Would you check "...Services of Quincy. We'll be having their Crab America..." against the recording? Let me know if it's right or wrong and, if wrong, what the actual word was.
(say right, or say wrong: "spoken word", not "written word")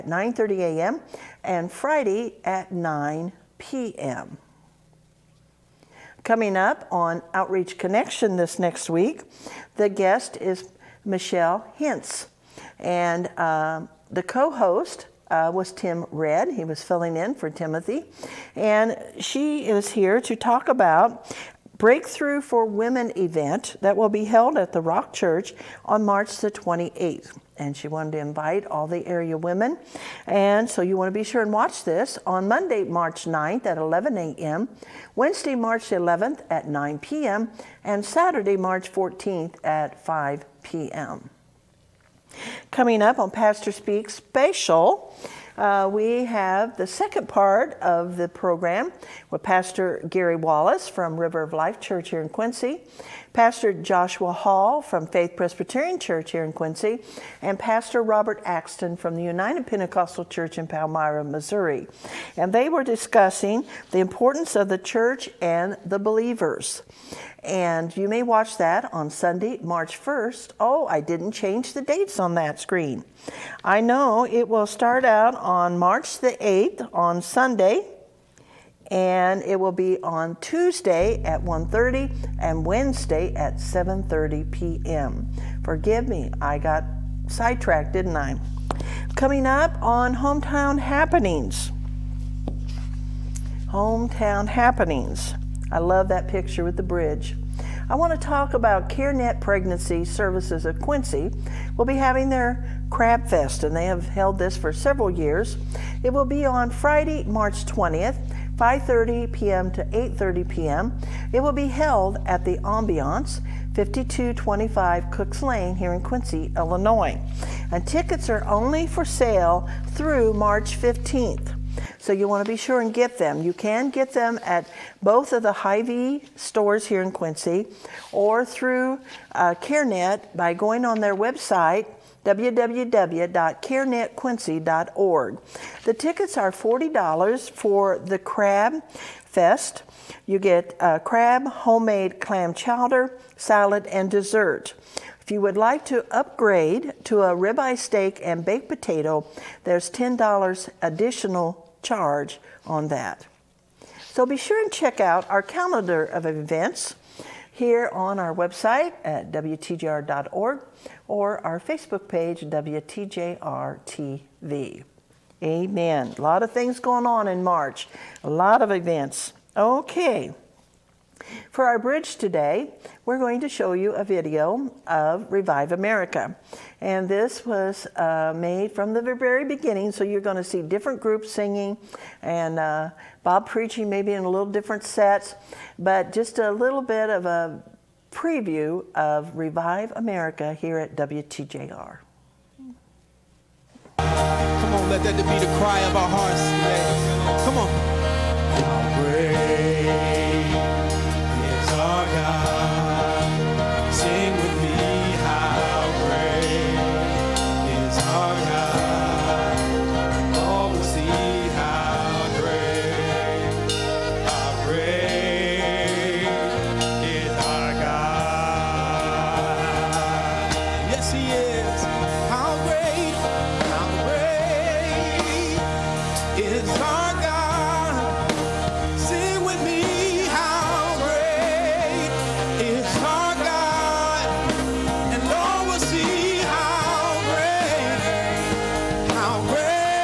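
wrong: "Fest", not "America".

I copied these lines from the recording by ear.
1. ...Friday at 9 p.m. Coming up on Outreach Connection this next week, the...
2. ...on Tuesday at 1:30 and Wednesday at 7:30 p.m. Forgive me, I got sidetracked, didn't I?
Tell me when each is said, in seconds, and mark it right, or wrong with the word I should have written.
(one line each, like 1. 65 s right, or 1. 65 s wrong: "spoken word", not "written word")
1. 1 s right
2. 80 s right.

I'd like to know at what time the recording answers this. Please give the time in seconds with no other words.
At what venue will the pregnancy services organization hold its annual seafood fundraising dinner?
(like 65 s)
112 s.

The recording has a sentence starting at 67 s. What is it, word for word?
And you may watch that on Sunday, March 1st.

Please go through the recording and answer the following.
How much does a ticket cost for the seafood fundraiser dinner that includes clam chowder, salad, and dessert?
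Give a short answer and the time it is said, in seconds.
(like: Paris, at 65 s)
$40, at 136 s.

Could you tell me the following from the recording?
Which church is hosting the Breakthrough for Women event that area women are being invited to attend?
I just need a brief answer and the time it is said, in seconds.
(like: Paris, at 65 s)
Rock Church, at 24 s.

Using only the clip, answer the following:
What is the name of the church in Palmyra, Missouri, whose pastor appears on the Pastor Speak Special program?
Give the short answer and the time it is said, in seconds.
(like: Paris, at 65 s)
United Pentecostal Church, at 59 s.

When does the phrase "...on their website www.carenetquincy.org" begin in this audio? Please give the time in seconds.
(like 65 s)
130 s.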